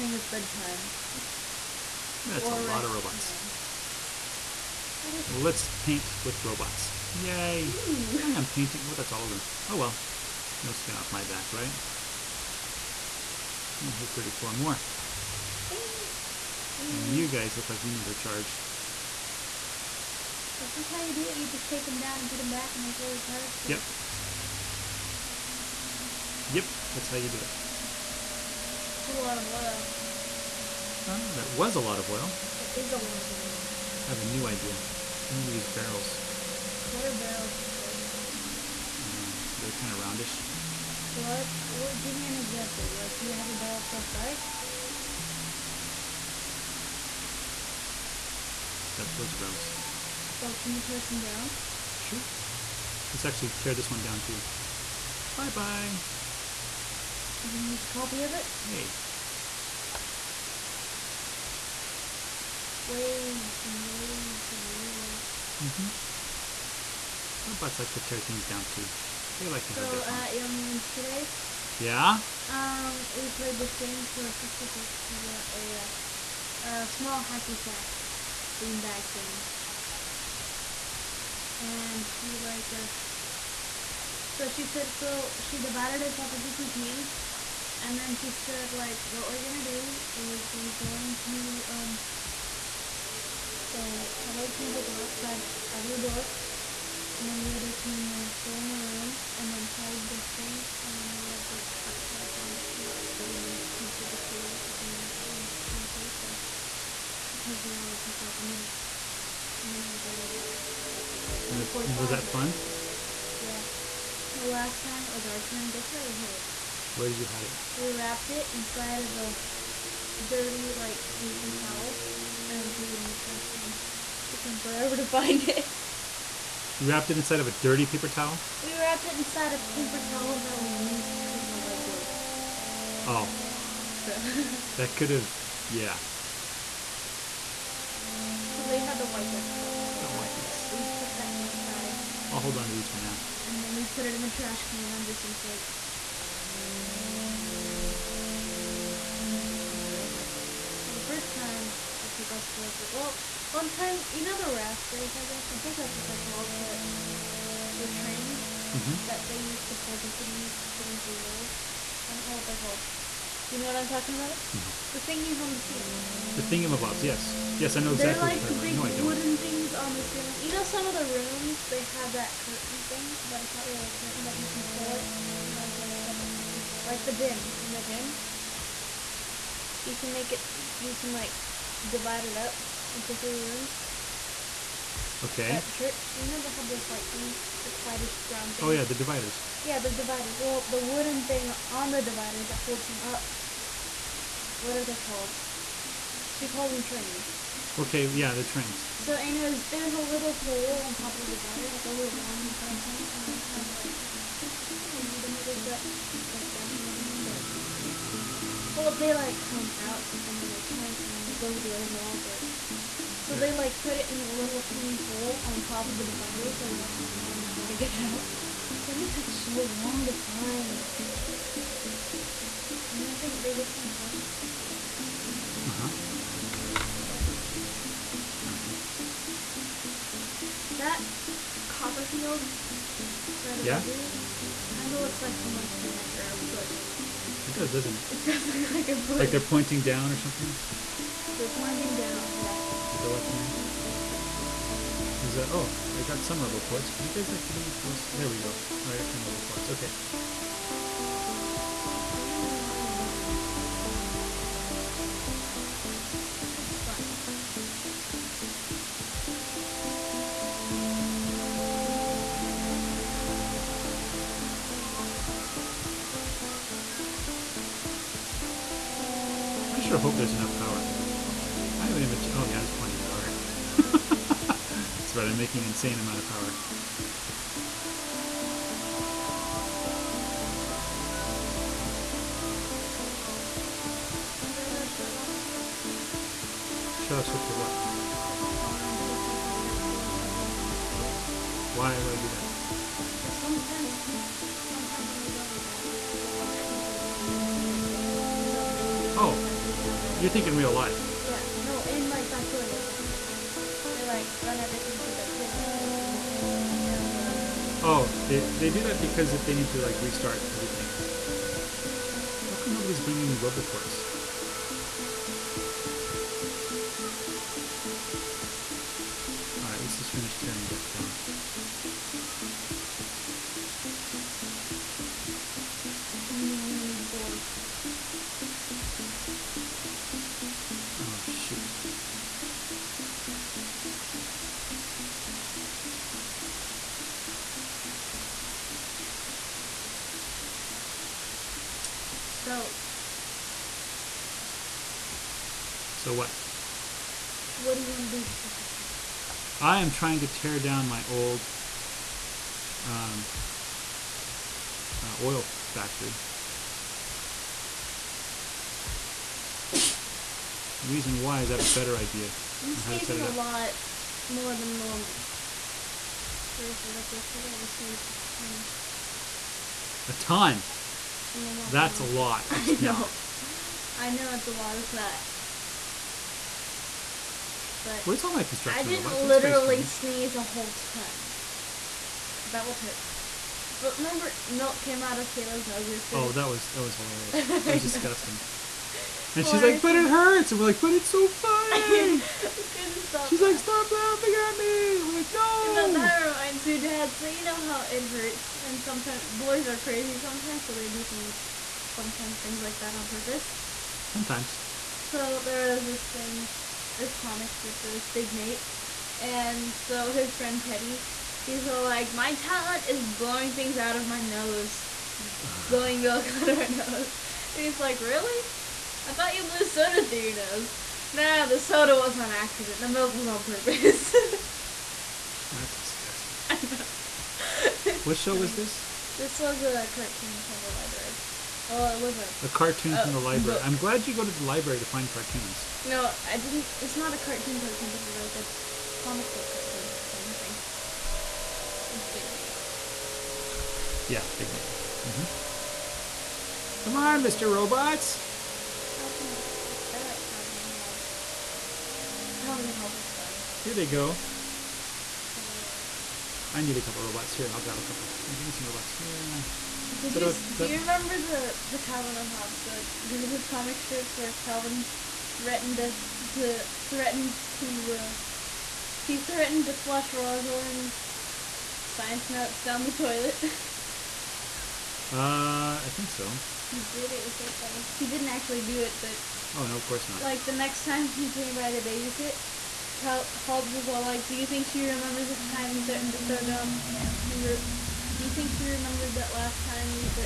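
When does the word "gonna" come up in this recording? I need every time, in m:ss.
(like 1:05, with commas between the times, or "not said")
0:57, 1:29.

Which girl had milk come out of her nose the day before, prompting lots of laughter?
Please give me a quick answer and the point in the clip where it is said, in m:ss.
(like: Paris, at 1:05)
Kayla, at 6:25.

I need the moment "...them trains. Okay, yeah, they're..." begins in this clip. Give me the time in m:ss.
3:16.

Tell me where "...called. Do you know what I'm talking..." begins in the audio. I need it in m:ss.
2:42.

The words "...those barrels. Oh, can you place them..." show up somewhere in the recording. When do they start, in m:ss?
0:49.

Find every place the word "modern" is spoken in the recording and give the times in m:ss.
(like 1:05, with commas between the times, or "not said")
not said.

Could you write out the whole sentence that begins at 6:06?
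Seriously, like yesterday, I sneezed a ton.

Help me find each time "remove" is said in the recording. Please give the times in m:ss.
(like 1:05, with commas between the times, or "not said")
not said.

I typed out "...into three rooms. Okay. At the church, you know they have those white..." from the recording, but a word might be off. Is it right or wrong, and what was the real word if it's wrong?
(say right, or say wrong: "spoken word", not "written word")
right.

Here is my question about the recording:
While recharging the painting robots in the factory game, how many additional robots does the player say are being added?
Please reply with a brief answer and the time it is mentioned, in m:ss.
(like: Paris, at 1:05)
34, at 0:14.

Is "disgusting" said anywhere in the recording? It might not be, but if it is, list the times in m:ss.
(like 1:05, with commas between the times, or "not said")
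6:27, 7:05.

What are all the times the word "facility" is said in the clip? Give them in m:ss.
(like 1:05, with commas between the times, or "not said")
not said.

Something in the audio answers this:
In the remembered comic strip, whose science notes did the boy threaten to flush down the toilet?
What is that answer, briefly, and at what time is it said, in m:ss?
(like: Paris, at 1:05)
Rosalyn's, at 7:50.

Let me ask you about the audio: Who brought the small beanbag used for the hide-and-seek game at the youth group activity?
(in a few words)
Sister Fitz.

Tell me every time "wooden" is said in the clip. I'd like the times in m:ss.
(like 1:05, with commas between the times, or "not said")
2:49, 3:10.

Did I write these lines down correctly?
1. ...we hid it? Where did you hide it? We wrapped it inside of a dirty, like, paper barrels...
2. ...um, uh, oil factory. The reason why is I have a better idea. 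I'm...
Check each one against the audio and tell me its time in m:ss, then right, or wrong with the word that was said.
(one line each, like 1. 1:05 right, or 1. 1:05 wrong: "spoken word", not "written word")
1. 1:56 wrong: "towels", not "barrels"
2. 5:52 right.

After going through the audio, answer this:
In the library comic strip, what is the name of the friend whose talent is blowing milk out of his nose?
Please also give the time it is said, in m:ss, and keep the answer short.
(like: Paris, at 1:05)
Teddy, at 6:50.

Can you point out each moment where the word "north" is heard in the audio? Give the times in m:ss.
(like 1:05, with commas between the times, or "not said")
not said.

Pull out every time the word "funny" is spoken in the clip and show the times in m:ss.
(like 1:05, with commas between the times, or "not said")
6:31, 7:57.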